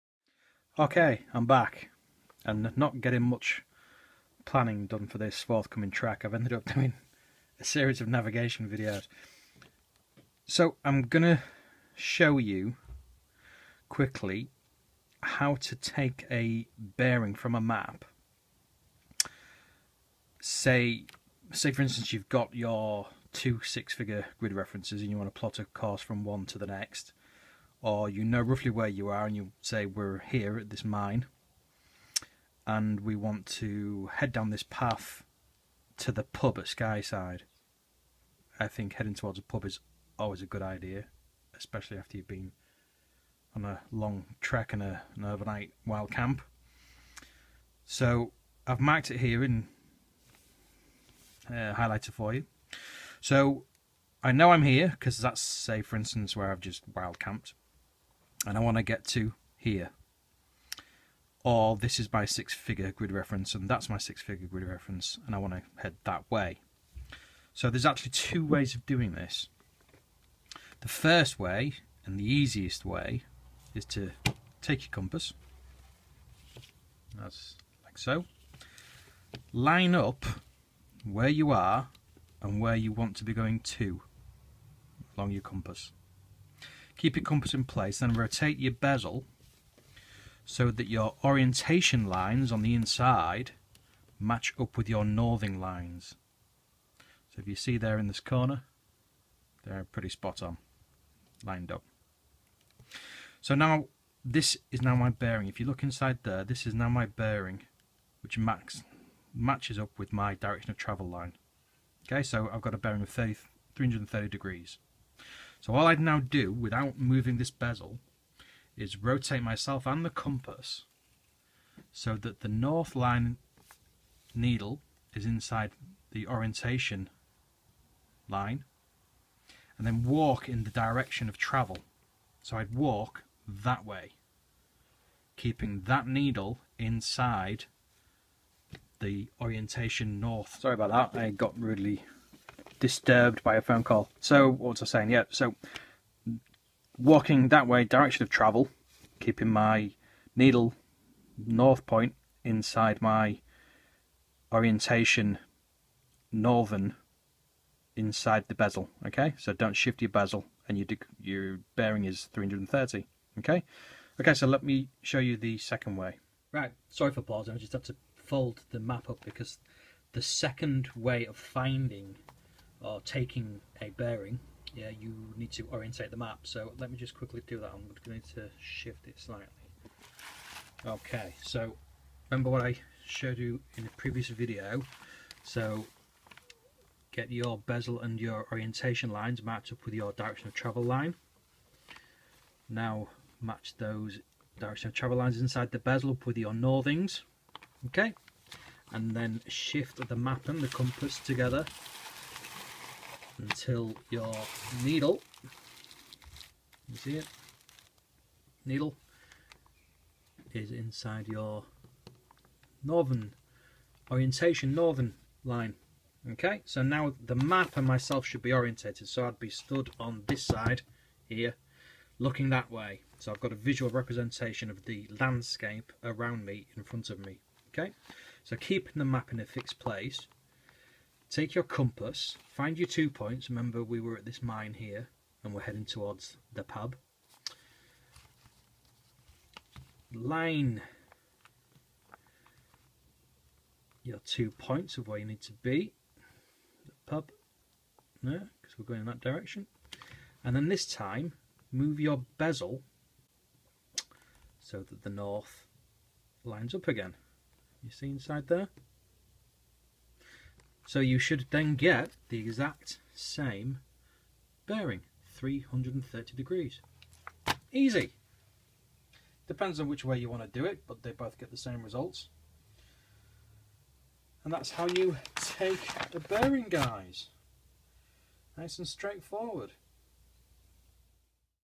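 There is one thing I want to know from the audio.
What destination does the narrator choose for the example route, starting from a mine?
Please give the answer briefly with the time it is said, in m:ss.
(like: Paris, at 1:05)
The pub at Skyside, at 0:36.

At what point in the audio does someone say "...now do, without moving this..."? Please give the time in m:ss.
1:55.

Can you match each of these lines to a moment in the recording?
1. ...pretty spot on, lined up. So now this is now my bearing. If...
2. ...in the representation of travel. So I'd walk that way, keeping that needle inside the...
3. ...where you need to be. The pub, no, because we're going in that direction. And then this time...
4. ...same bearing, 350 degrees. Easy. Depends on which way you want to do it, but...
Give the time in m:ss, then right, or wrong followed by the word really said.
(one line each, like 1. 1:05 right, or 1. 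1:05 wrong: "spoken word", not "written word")
1. 1:39 right
2. 2:10 wrong: "direction", not "representation"
3. 4:05 right
4. 4:23 wrong: "330", not "350".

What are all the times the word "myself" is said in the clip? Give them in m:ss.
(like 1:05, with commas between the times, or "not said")
1:59, 3:37.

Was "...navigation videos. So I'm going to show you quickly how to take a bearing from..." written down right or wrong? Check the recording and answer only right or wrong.
right.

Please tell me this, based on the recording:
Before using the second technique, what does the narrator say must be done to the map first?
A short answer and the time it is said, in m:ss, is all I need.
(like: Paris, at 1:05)
Orientate the map, at 2:55.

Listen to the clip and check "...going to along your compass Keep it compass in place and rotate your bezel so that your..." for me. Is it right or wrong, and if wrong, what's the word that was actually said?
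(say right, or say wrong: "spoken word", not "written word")
right.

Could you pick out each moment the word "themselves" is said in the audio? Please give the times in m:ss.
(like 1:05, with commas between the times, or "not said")
not said.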